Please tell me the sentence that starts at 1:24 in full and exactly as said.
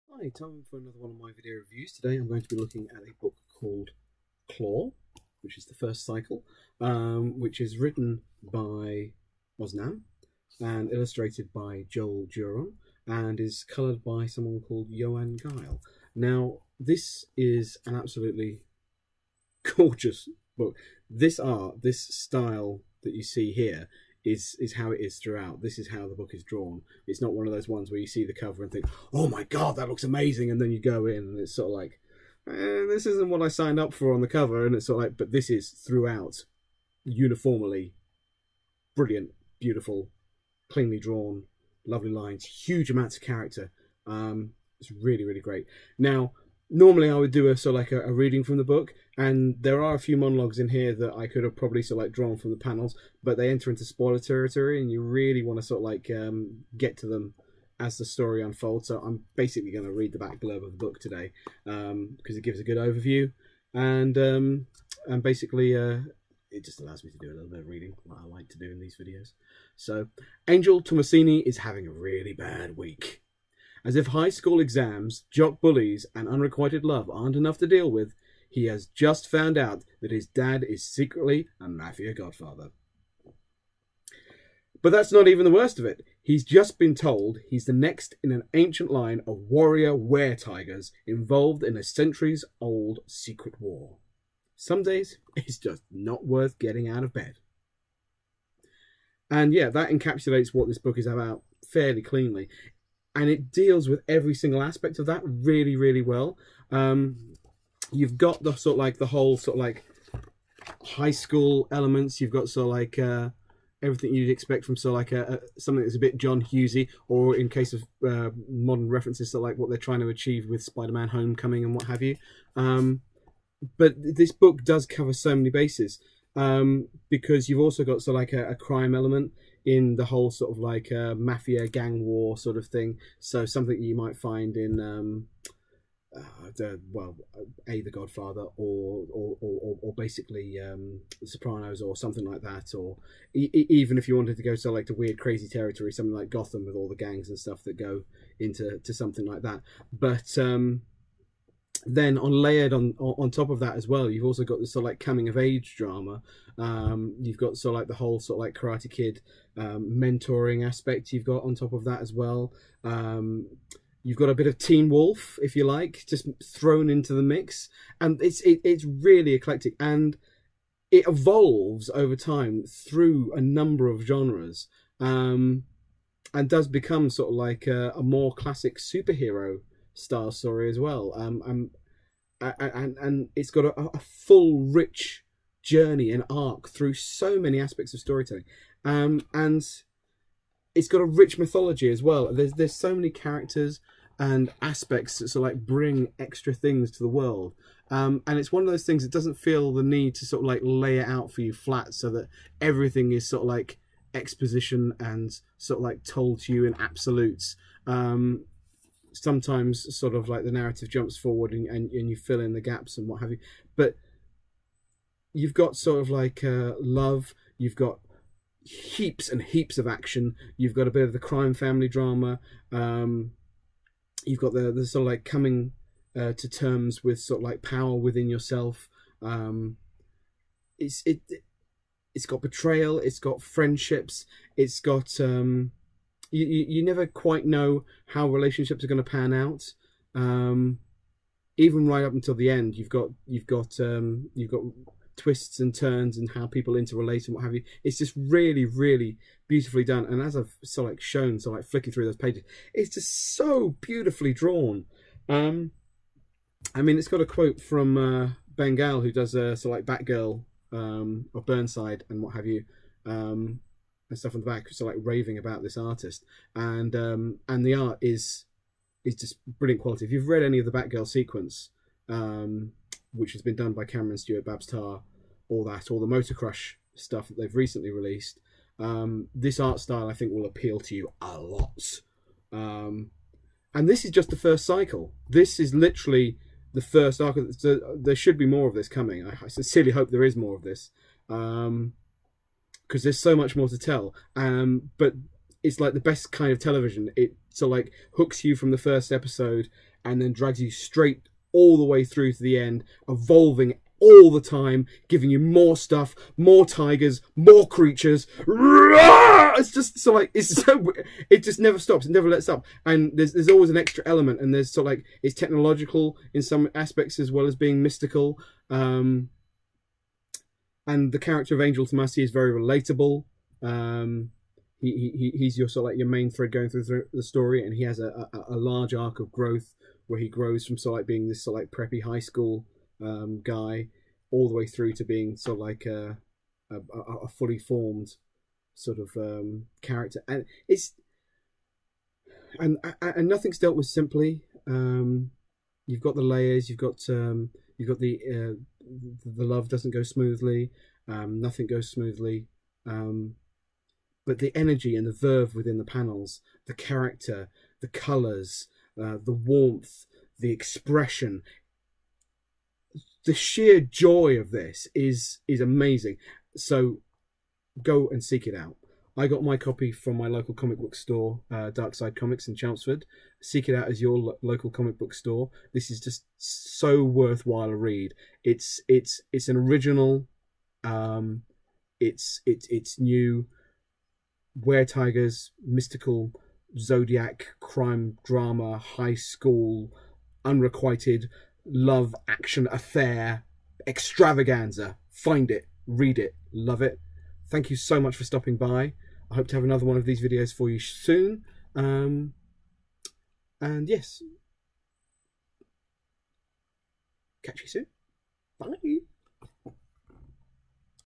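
But that's not even the worst of it.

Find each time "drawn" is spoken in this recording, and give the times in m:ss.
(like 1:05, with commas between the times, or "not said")
0:26, 0:40, 0:52, 4:14.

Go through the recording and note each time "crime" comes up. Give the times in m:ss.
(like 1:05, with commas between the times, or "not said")
2:08, 3:41, 6:27.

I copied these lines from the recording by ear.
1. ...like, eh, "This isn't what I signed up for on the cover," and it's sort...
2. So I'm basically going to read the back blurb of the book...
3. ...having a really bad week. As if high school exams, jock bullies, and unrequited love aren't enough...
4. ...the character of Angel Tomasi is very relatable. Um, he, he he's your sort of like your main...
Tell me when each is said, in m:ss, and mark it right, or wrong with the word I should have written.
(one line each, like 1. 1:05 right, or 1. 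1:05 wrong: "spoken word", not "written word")
1. 0:31 right
2. 0:58 right
3. 1:11 right
4. 5:21 right.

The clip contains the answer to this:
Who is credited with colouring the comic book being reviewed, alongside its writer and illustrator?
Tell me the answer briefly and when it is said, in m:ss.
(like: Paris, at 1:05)
Yoann Guille, at 0:14.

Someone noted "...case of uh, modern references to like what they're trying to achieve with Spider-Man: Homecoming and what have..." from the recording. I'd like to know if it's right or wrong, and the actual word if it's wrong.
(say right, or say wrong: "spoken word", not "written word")
right.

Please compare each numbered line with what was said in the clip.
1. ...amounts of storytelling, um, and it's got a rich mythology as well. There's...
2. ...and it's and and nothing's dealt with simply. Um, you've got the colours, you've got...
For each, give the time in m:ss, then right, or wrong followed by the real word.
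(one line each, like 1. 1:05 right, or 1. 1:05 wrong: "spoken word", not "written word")
1. 3:07 wrong: "aspects", not "amounts"
2. 5:40 wrong: "layers", not "colours".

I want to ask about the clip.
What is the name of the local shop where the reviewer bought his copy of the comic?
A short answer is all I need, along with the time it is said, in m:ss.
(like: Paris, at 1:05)
Dark Side Comics, at 6:11.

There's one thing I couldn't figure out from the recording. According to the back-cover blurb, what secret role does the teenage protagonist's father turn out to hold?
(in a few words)
mafia godfather.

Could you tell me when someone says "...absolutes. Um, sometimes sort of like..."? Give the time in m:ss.
3:26.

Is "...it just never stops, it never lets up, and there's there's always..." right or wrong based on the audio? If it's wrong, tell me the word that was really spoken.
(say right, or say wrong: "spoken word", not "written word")
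right.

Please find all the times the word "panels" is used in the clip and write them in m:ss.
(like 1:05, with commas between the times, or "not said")
0:52, 5:55.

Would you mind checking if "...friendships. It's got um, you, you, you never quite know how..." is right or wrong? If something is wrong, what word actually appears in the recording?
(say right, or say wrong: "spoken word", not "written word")
right.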